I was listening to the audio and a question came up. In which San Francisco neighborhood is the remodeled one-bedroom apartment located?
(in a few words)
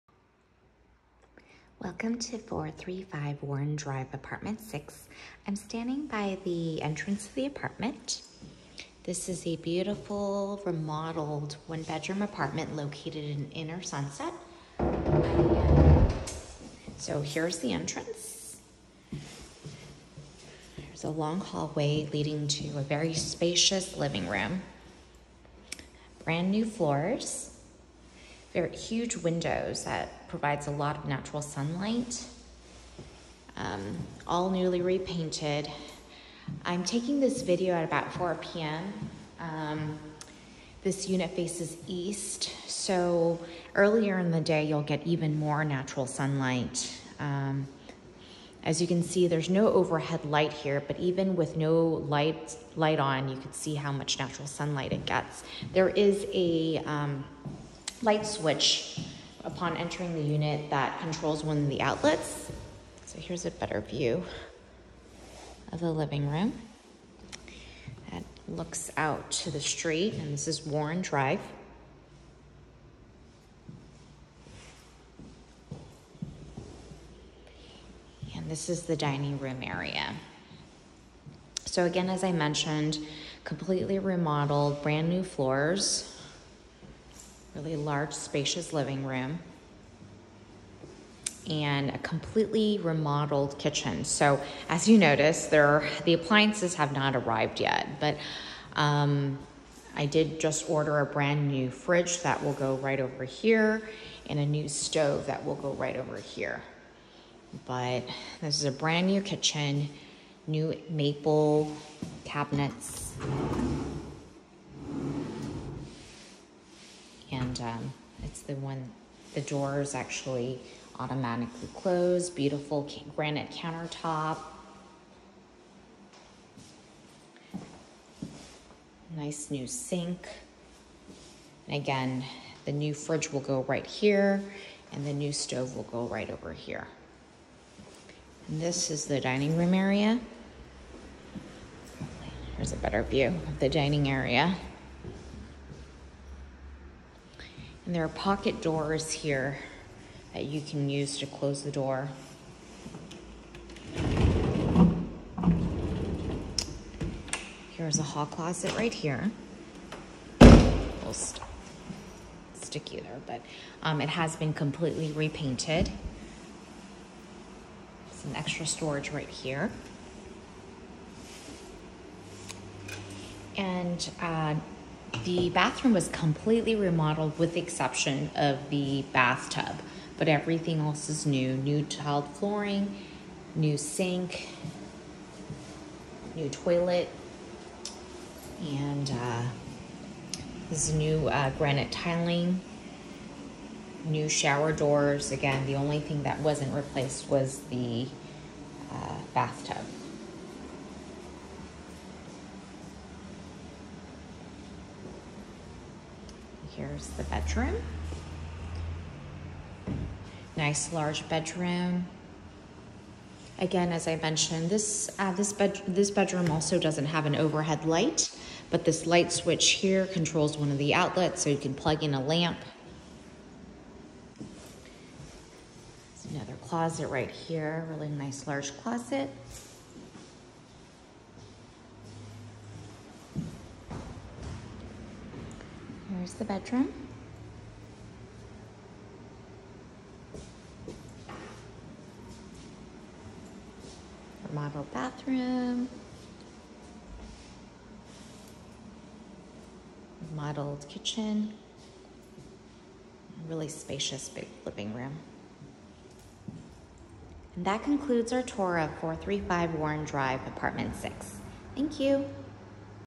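Inner Sunset.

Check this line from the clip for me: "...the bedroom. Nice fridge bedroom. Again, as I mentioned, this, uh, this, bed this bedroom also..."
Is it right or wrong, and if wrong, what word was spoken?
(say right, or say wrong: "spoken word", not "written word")
wrong: "large", not "fridge".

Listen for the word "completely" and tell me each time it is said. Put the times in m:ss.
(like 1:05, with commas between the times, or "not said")
1:23, 1:31, 2:44, 2:56.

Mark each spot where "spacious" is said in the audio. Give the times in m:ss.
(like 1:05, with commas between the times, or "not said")
0:23, 1:28, 4:13.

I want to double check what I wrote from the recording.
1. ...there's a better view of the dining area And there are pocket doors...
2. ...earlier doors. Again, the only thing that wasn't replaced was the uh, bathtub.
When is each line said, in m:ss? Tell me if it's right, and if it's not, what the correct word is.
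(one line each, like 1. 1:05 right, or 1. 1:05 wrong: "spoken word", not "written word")
1. 2:22 right
2. 3:14 wrong: "shower", not "earlier".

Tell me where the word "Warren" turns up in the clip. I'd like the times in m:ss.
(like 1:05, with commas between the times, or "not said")
0:03, 1:10, 4:19.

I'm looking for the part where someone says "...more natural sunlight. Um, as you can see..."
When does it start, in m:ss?
0:45.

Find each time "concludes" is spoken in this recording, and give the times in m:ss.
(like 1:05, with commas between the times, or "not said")
4:17.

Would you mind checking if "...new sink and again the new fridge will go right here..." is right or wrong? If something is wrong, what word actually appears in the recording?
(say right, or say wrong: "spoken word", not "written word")
right.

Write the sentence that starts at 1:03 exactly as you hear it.
So here's a better view of the living room.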